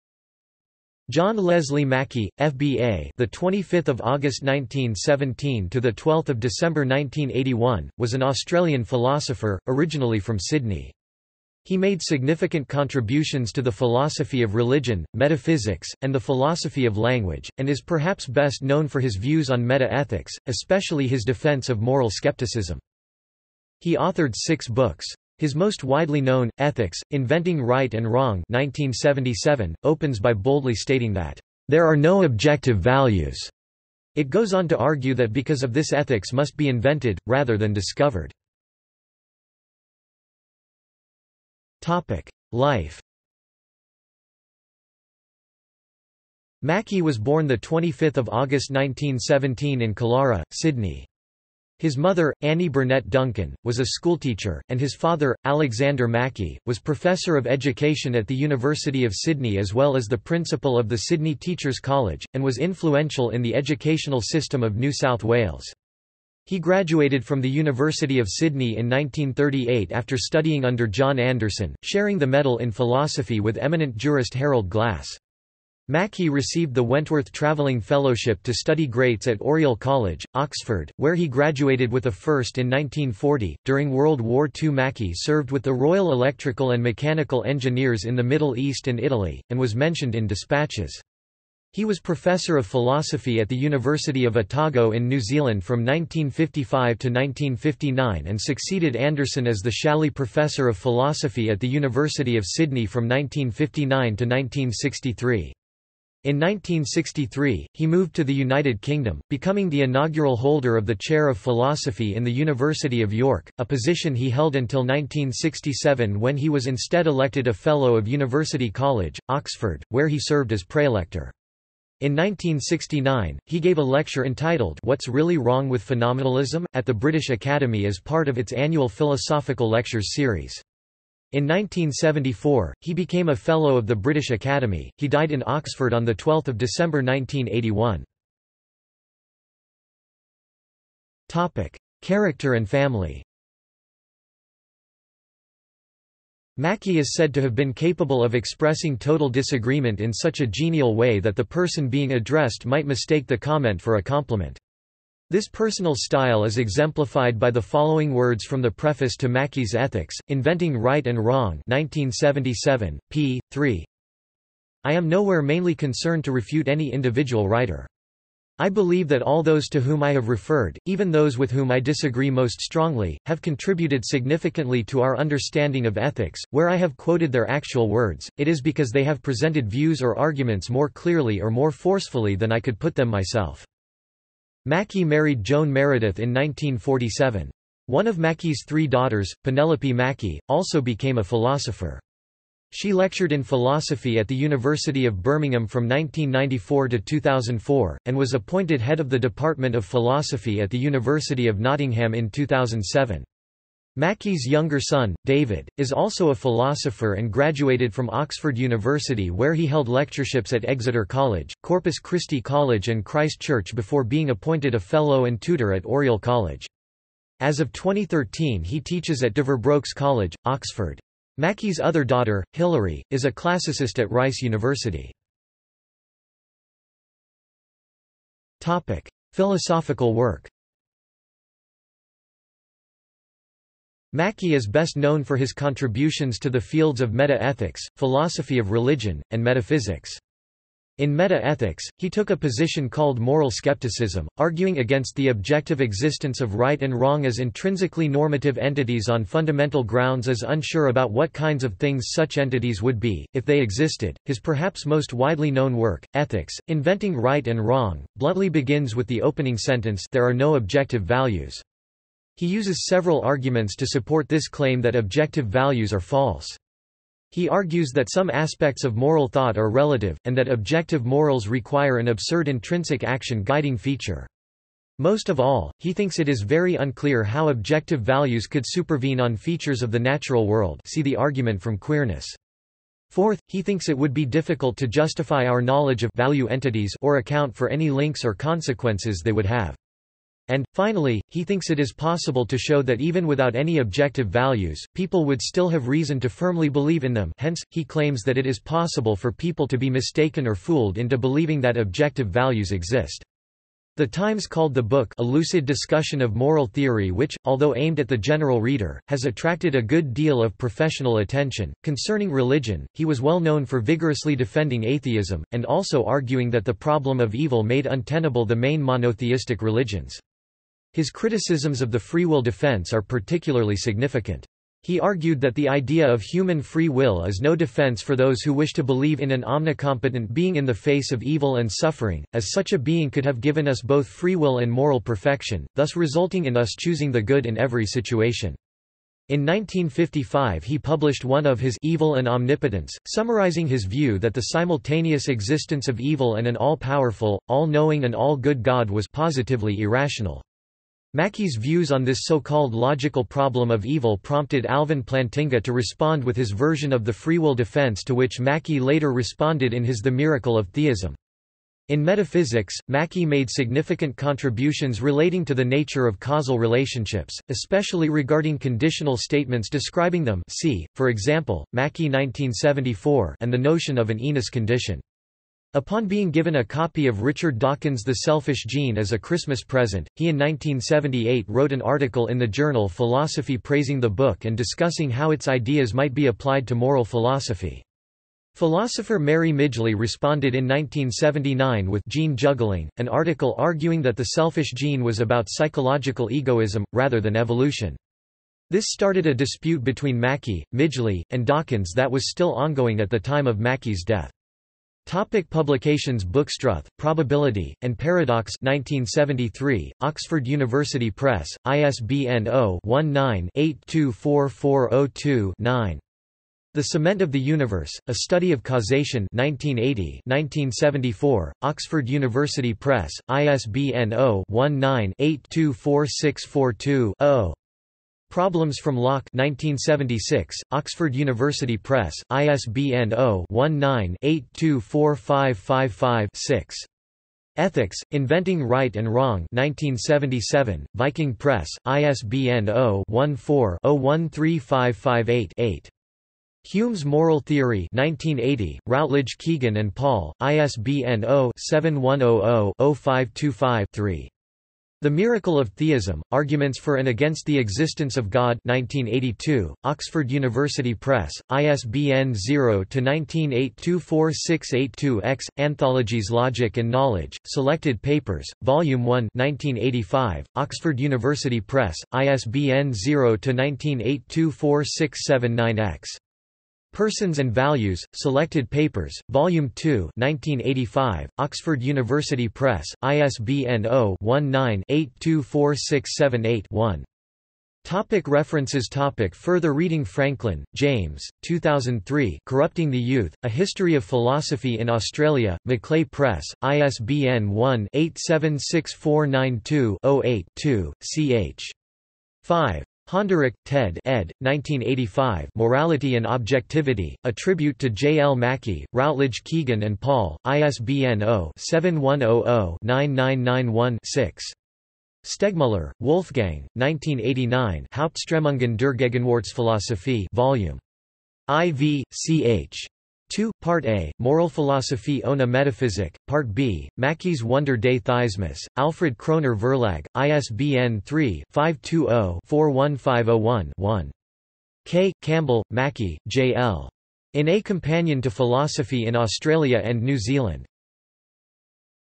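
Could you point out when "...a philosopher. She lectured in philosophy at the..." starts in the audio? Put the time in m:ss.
3:11.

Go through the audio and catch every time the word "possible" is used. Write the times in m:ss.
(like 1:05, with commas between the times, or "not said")
4:51, 4:58.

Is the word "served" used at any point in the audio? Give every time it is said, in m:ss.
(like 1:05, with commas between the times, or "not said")
1:25, 2:00.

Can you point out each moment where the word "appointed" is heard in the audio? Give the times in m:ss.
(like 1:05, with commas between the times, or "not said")
3:18, 3:34.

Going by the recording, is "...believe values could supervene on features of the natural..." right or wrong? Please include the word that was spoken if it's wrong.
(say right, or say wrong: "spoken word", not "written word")
wrong: "objective", not "believe".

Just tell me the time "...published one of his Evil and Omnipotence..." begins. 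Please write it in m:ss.
5:40.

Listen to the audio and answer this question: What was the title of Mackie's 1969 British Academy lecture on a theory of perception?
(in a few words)
What's Really Wrong with Phenomenalism?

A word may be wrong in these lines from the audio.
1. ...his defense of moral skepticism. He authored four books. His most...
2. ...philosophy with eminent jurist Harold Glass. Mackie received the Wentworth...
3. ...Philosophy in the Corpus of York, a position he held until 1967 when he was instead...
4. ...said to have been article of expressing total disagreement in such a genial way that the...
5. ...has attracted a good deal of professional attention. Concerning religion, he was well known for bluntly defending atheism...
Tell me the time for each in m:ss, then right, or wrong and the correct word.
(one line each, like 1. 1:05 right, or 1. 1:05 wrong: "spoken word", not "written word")
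1. 0:21 wrong: "six", not "four"
2. 1:12 right
3. 1:51 wrong: "University", not "Corpus"
4. 2:27 wrong: "capable", not "article"
5. 5:09 wrong: "vigorously", not "bluntly".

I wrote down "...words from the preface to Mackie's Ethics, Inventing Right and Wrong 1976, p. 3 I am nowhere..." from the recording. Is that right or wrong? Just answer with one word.
wrong.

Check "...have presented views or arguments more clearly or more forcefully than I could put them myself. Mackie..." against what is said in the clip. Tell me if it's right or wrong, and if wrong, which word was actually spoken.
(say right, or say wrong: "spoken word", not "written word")
right.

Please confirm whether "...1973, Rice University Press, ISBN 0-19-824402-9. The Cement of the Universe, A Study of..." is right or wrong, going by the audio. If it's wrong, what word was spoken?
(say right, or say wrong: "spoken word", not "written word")
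wrong: "Oxford", not "Rice".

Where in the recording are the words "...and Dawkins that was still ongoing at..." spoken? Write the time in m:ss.
6:41.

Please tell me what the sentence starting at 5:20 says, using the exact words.
His criticisms of the free will defense are particularly significant.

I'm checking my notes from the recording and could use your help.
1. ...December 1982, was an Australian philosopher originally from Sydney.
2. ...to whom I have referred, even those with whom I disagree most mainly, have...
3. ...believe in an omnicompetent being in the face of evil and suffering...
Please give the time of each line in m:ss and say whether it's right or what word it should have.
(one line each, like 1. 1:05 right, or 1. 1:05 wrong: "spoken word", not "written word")
1. 0:06 wrong: "1981", not "1982"
2. 2:49 wrong: "strongly", not "mainly"
3. 5:28 right.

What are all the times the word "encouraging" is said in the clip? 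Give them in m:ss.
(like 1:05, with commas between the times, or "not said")
not said.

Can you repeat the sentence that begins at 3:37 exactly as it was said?
As of 2013 he teaches at Deverbrooks College, Oxford.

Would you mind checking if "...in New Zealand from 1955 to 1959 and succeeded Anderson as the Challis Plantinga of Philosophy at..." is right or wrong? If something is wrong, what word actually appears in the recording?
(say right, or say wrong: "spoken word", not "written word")
wrong: "Professor", not "Plantinga".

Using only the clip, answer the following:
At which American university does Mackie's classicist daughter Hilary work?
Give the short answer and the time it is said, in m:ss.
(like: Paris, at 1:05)
Rice University, at 3:44.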